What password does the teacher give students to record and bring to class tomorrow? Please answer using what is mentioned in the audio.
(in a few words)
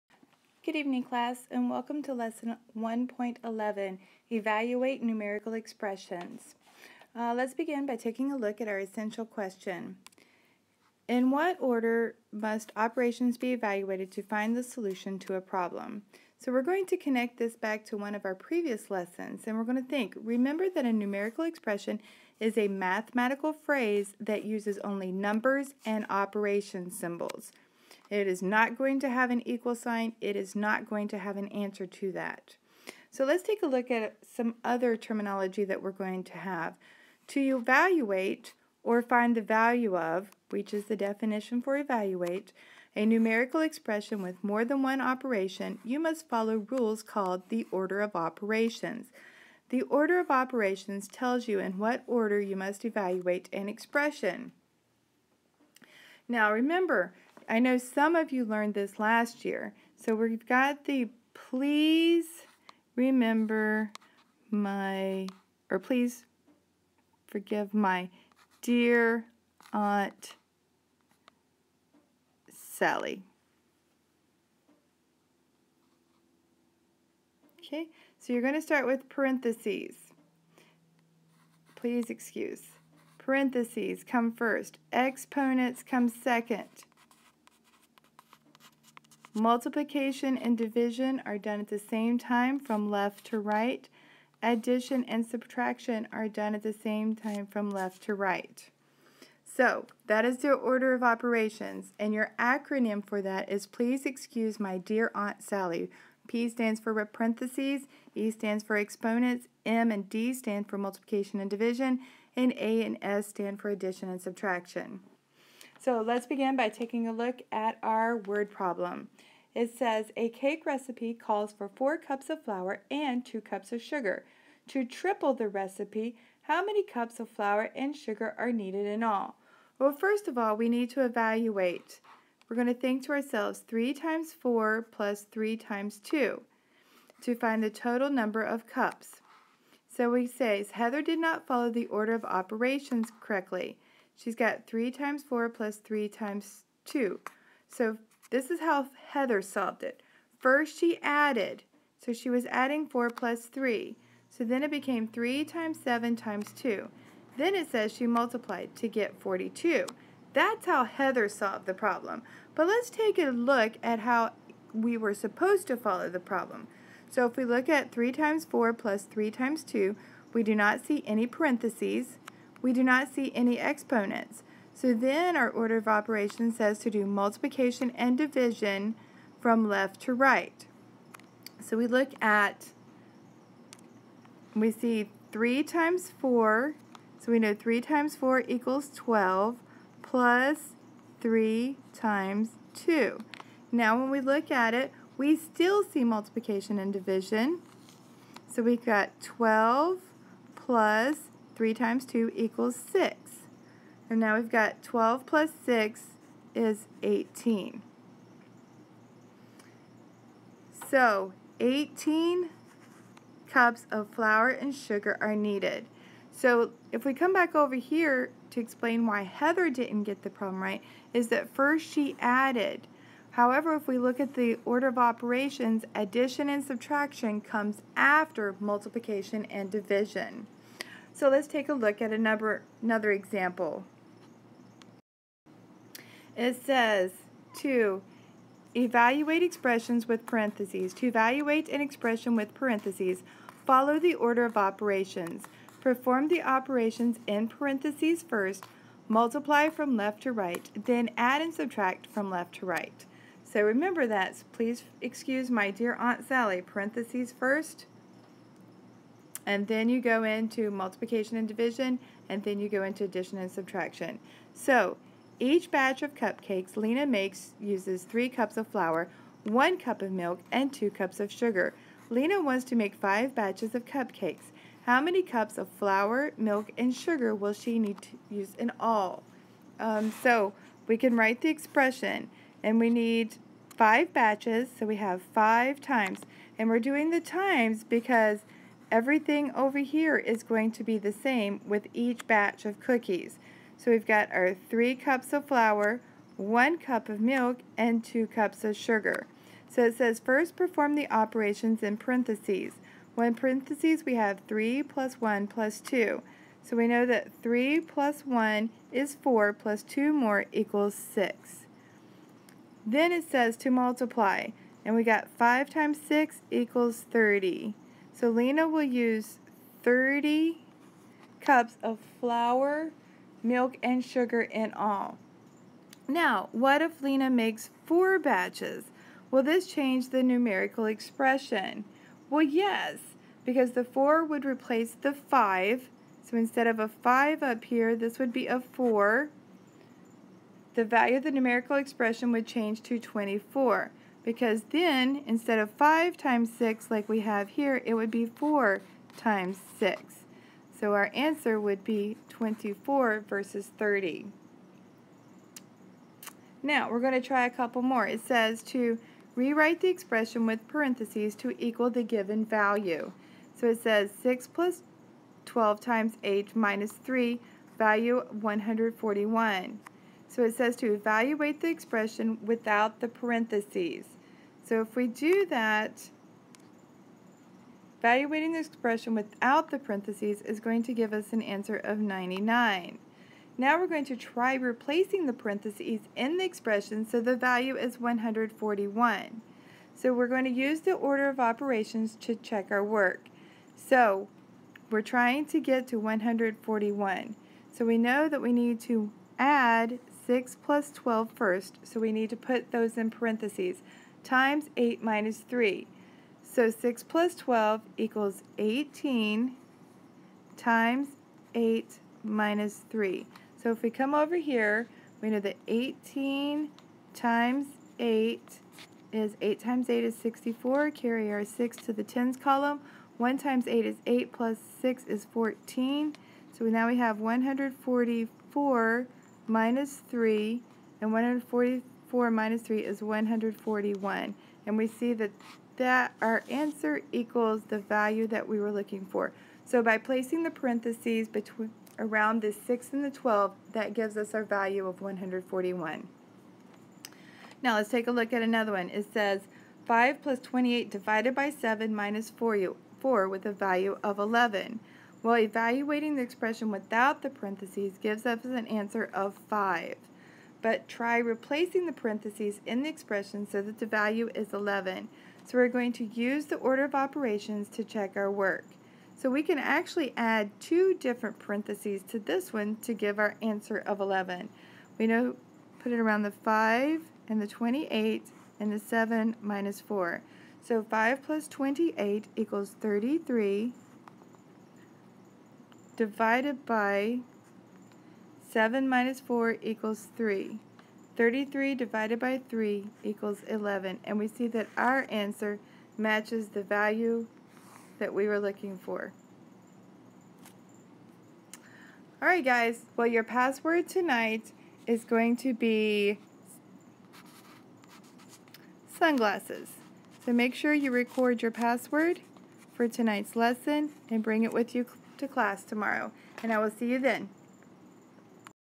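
sunglasses.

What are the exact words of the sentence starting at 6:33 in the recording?
So we're trying to get to 141.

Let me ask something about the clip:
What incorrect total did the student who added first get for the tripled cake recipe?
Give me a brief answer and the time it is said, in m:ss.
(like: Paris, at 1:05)
42, at 2:39.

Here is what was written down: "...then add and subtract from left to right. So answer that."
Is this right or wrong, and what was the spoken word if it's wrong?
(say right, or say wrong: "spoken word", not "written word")
wrong: "remember", not "answer".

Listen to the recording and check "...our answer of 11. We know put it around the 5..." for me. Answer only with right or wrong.
right.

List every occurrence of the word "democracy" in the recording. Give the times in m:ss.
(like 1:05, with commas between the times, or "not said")
not said.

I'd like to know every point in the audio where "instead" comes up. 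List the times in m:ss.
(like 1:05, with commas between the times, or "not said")
5:36, 5:45.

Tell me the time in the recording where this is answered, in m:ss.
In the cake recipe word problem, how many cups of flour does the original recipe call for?
2:01.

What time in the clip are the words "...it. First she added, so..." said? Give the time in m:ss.
2:29.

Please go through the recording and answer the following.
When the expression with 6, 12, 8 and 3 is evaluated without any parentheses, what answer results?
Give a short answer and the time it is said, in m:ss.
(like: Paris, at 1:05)
99, at 6:21.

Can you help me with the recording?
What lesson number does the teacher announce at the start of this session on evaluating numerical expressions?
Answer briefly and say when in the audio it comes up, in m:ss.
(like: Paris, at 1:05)
1.11, at 0:02.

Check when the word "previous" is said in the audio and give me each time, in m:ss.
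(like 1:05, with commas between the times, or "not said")
0:18.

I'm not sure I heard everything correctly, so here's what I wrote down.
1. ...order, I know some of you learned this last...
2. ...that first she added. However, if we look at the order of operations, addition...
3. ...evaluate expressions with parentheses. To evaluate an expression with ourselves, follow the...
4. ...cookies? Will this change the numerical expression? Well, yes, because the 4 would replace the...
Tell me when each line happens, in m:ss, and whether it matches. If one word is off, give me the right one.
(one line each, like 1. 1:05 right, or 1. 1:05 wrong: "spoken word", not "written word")
1. 0:56 wrong: "remember", not "order"
2. 3:41 right
3. 3:58 wrong: "parentheses", not "ourselves"
4. 5:28 wrong: "batches", not "cookies".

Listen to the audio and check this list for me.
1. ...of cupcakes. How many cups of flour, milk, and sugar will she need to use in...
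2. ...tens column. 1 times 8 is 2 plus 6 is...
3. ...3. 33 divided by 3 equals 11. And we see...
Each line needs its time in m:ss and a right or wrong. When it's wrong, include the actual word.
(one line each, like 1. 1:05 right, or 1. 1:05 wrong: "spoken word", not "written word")
1. 4:33 right
2. 7:02 wrong: "8", not "2"
3. 8:10 right.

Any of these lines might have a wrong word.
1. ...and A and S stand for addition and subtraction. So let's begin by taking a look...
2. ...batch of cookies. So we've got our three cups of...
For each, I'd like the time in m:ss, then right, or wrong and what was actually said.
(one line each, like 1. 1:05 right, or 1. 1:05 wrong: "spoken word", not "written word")
1. 1:52 right
2. 4:52 right.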